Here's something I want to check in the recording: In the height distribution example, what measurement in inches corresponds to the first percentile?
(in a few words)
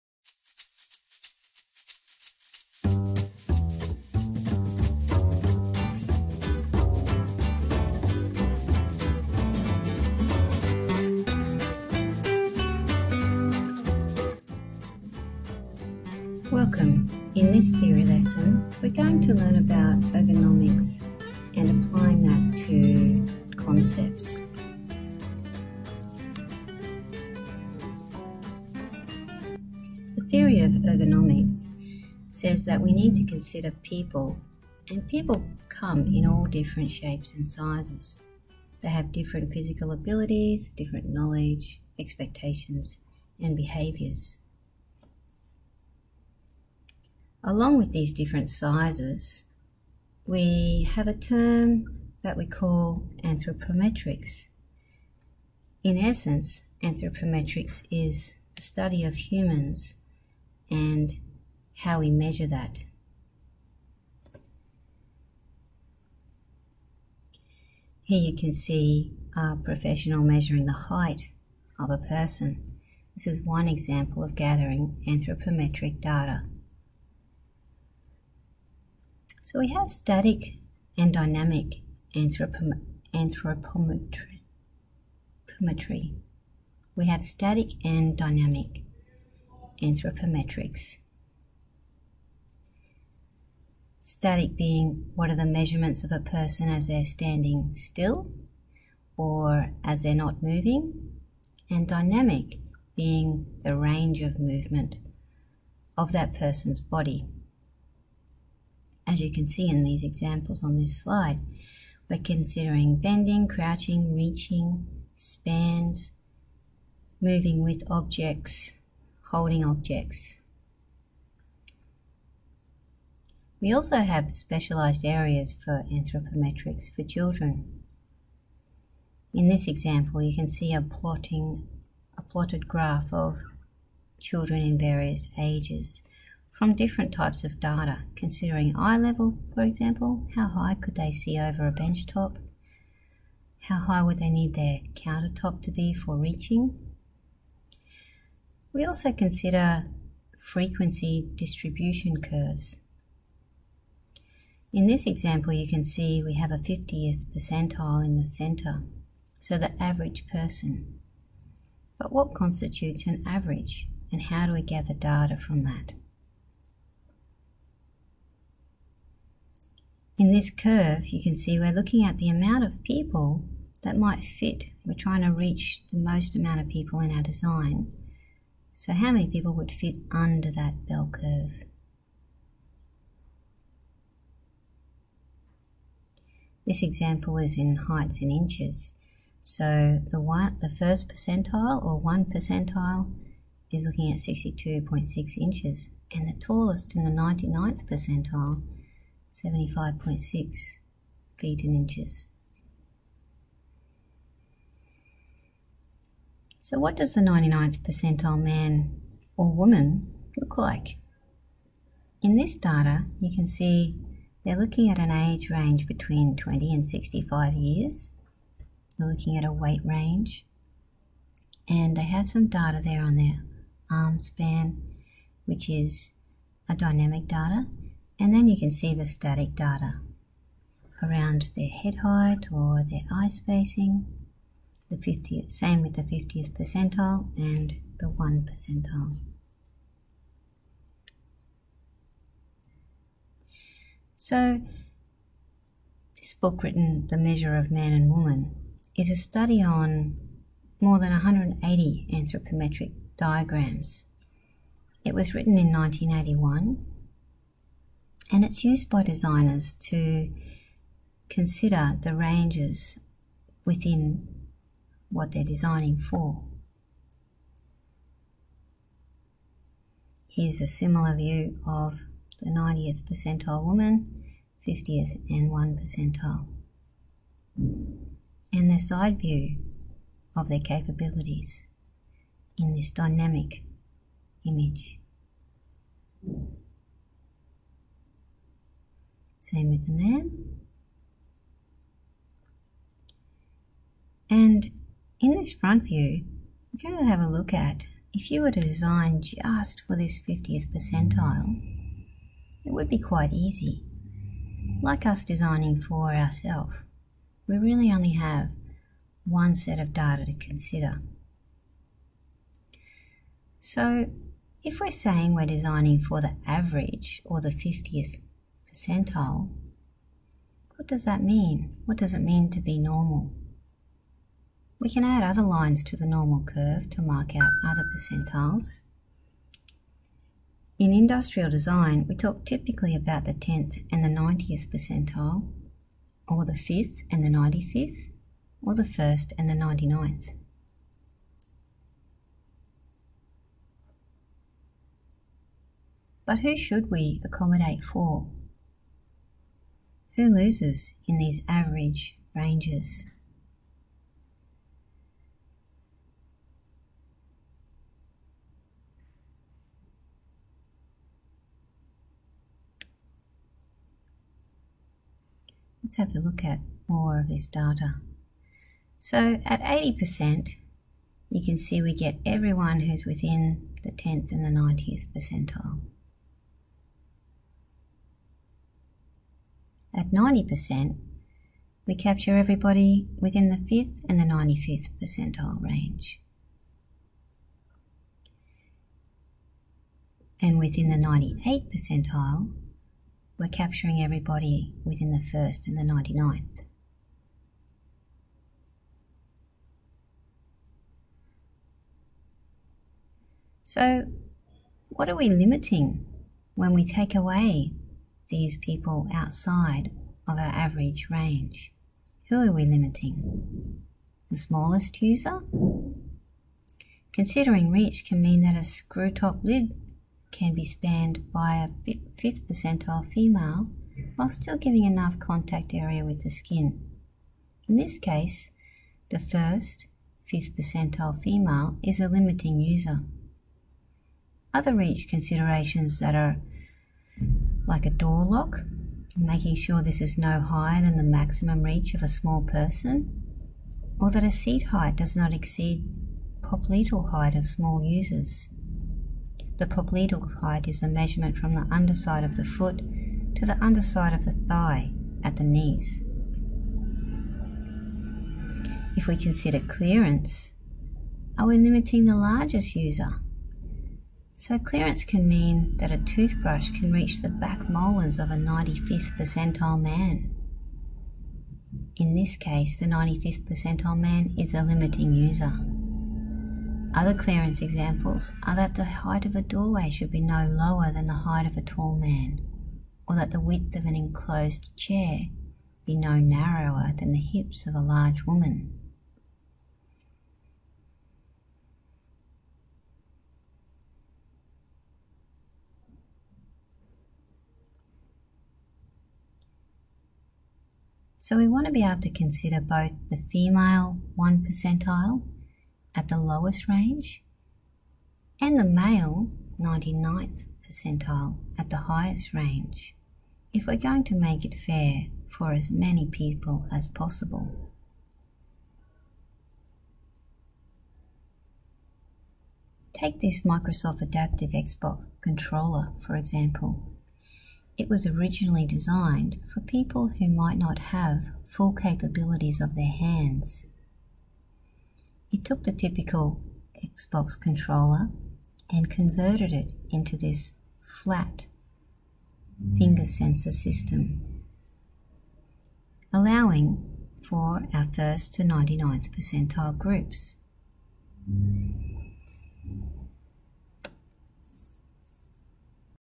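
62.6 inches.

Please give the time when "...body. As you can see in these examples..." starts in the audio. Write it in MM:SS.
01:46.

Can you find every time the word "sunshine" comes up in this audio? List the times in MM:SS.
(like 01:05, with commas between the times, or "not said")
not said.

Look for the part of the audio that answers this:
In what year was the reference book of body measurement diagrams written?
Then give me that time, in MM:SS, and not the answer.
04:15.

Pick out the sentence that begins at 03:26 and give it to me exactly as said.
So what does the 99th percentile man or woman look like?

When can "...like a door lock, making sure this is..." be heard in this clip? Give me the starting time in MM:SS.
07:17.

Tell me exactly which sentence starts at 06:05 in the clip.
Let's have a look at more of this data.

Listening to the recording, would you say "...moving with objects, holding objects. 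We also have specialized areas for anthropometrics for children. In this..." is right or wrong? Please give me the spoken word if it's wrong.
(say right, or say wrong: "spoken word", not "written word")
right.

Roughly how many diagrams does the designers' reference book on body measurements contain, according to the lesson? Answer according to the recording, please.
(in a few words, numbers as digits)
more than 180.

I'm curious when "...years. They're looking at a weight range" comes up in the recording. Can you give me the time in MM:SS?
03:37.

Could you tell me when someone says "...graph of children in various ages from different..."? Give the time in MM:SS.
02:12.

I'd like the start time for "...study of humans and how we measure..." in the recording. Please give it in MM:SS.
00:58.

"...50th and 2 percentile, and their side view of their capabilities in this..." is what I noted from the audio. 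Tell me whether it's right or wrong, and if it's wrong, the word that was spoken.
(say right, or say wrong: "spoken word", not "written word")
wrong: "1", not "2".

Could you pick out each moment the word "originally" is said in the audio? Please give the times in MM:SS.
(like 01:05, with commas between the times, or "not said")
08:48.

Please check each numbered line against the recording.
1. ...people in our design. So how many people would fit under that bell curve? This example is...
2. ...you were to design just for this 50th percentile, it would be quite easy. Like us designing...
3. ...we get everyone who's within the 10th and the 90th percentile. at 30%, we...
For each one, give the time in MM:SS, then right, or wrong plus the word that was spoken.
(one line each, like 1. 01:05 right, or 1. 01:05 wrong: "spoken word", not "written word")
1. 02:56 right
2. 04:58 right
3. 06:11 wrong: "90", not "30".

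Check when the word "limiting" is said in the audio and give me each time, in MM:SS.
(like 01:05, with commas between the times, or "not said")
06:45, 06:52, 07:12, 07:41, 07:54.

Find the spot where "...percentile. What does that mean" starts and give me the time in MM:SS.
05:18.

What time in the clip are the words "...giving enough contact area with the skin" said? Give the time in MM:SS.
07:04.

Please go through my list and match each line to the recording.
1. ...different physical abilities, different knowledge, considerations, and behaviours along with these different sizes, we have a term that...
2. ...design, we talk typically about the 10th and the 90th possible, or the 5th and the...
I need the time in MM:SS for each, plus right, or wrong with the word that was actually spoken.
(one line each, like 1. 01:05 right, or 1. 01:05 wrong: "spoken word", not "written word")
1. 00:39 wrong: "expectations", not "considerations"
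2. 05:31 wrong: "percentile", not "possible".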